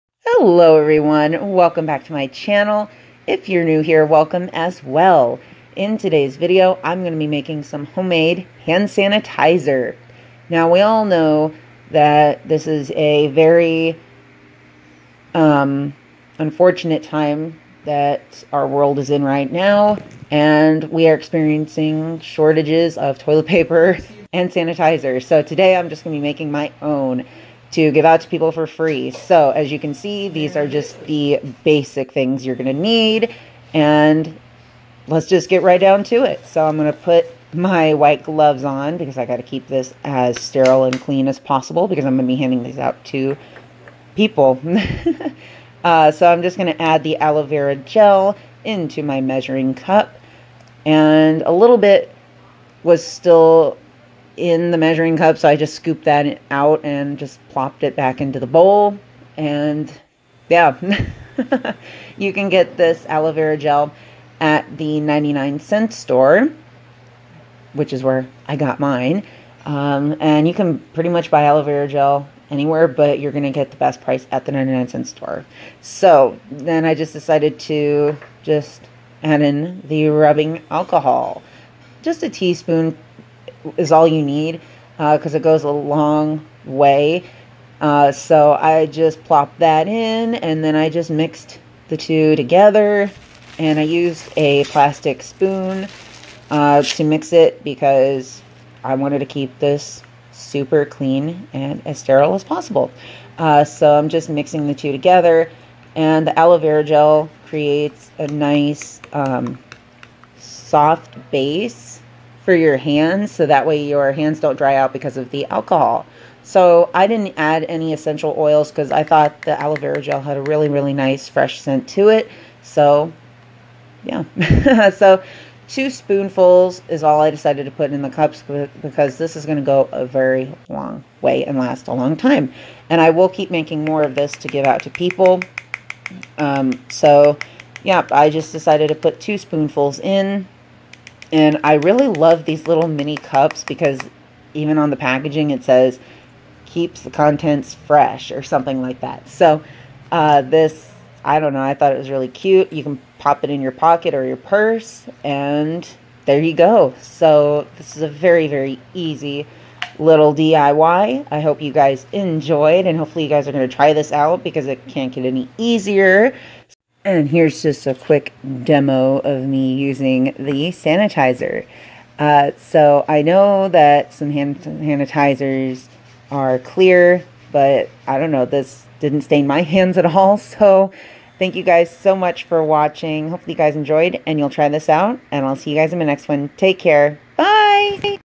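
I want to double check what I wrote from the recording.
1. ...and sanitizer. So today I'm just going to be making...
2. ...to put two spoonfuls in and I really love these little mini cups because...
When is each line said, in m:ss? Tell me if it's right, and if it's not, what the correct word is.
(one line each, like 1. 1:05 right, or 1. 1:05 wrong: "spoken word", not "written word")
1. 0:24 right
2. 2:18 right.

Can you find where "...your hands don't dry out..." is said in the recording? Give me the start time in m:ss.
1:53.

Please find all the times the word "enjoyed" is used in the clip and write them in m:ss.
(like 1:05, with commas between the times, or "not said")
2:42, 3:03.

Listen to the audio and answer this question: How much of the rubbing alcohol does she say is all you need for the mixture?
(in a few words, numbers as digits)
a teaspoon.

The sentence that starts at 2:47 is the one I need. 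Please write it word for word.
And here's just a quick demo of me using the sanitizer.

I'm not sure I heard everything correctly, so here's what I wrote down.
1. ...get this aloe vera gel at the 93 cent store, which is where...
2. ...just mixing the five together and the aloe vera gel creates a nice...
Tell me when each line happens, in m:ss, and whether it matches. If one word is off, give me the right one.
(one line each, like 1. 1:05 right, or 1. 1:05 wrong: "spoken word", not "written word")
1. 1:02 wrong: "99", not "93"
2. 1:44 wrong: "two", not "five".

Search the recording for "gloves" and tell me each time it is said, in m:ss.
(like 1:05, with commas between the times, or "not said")
0:38.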